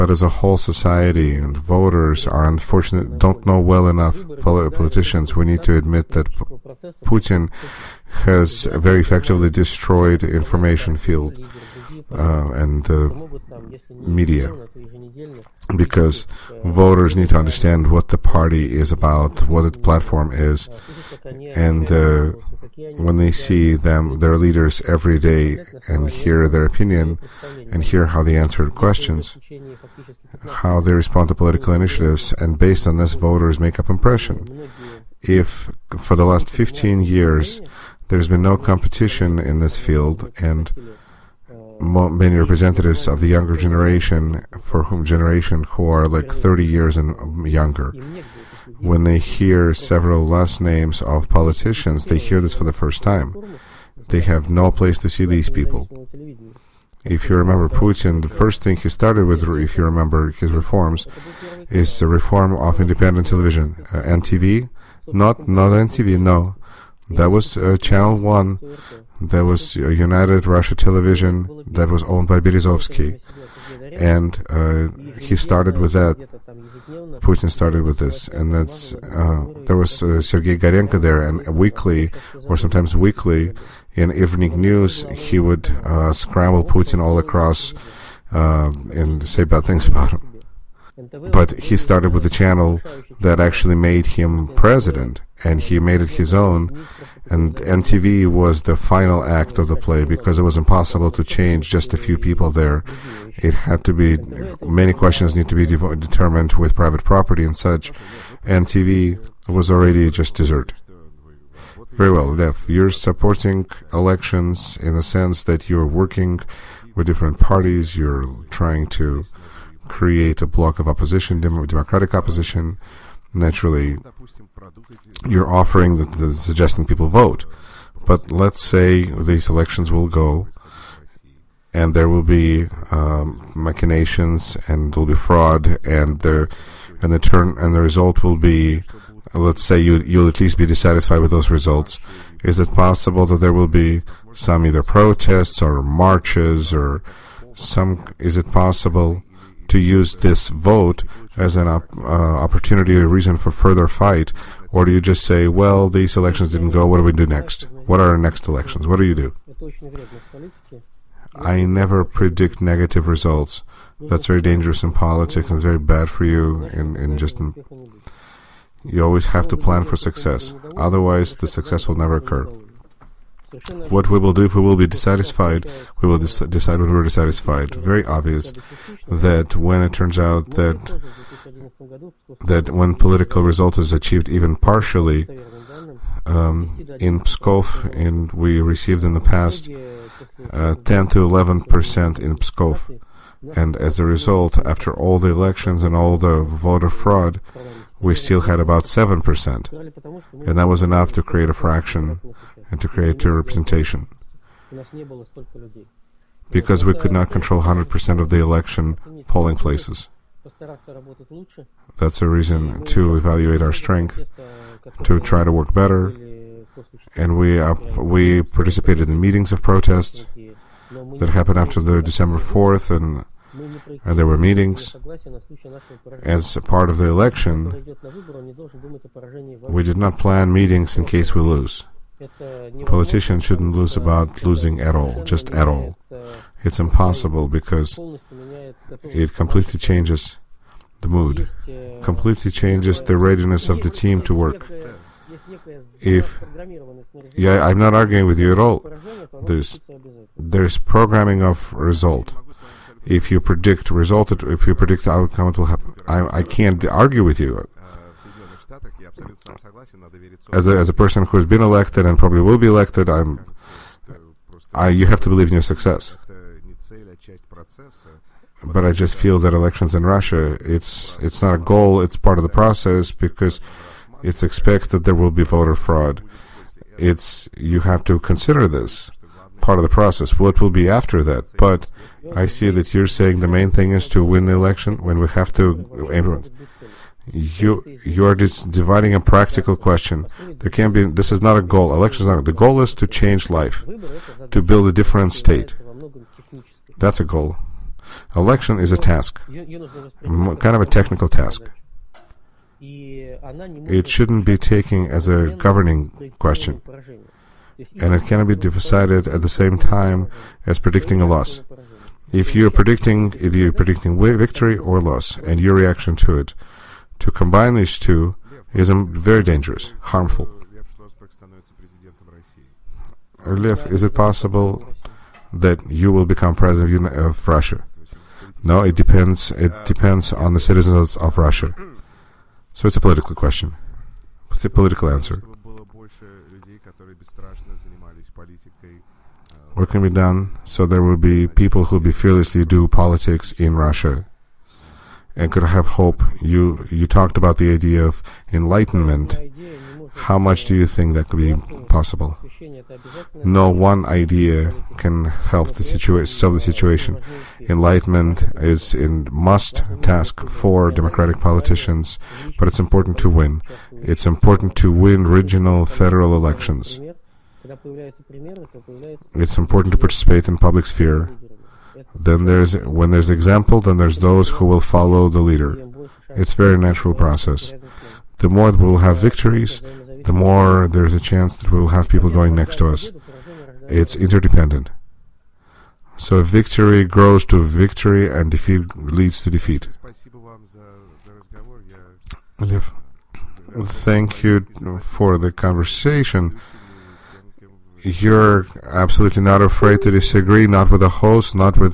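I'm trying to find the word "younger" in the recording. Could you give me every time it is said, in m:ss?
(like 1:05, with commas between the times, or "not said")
0:43, 0:47.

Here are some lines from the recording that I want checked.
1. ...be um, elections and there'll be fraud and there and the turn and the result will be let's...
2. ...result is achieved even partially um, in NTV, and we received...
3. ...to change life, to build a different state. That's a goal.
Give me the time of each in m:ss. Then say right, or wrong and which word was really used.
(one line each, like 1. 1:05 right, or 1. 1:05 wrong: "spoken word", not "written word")
1. 2:12 wrong: "machinations", not "elections"
2. 3:03 wrong: "Pskov", not "NTV"
3. 4:52 right.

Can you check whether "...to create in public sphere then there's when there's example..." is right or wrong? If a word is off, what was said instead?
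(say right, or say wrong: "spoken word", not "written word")
wrong: "participate", not "create".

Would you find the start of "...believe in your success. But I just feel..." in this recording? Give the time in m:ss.
4:25.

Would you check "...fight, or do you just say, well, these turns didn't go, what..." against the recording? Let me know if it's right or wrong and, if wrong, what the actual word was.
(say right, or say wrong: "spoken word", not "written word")
wrong: "elections", not "turns".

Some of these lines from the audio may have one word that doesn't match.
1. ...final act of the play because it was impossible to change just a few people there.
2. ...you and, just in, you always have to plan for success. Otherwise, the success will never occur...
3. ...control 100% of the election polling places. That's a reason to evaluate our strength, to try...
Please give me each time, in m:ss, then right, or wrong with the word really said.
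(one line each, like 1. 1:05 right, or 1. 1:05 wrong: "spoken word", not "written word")
1. 1:38 right
2. 2:46 right
3. 3:27 right.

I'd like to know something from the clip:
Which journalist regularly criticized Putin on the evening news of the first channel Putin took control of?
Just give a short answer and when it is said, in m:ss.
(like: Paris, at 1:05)
Sergei Dorenko, at 1:20.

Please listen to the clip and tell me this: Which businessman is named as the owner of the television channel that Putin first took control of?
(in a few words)
Berezovsky.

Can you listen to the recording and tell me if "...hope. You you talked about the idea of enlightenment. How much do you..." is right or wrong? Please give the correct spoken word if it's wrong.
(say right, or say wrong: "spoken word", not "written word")
right.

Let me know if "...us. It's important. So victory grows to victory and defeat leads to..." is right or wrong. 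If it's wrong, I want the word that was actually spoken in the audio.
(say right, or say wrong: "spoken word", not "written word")
wrong: "interdependent", not "important".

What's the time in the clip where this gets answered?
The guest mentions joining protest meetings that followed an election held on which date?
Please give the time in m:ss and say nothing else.
3:42.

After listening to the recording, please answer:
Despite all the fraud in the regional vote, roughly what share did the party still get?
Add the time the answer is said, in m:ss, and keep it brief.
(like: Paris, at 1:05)
7%, at 3:18.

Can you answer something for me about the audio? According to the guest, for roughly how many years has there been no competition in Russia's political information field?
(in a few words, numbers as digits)
15 years.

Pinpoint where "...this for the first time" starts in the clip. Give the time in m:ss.
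0:52.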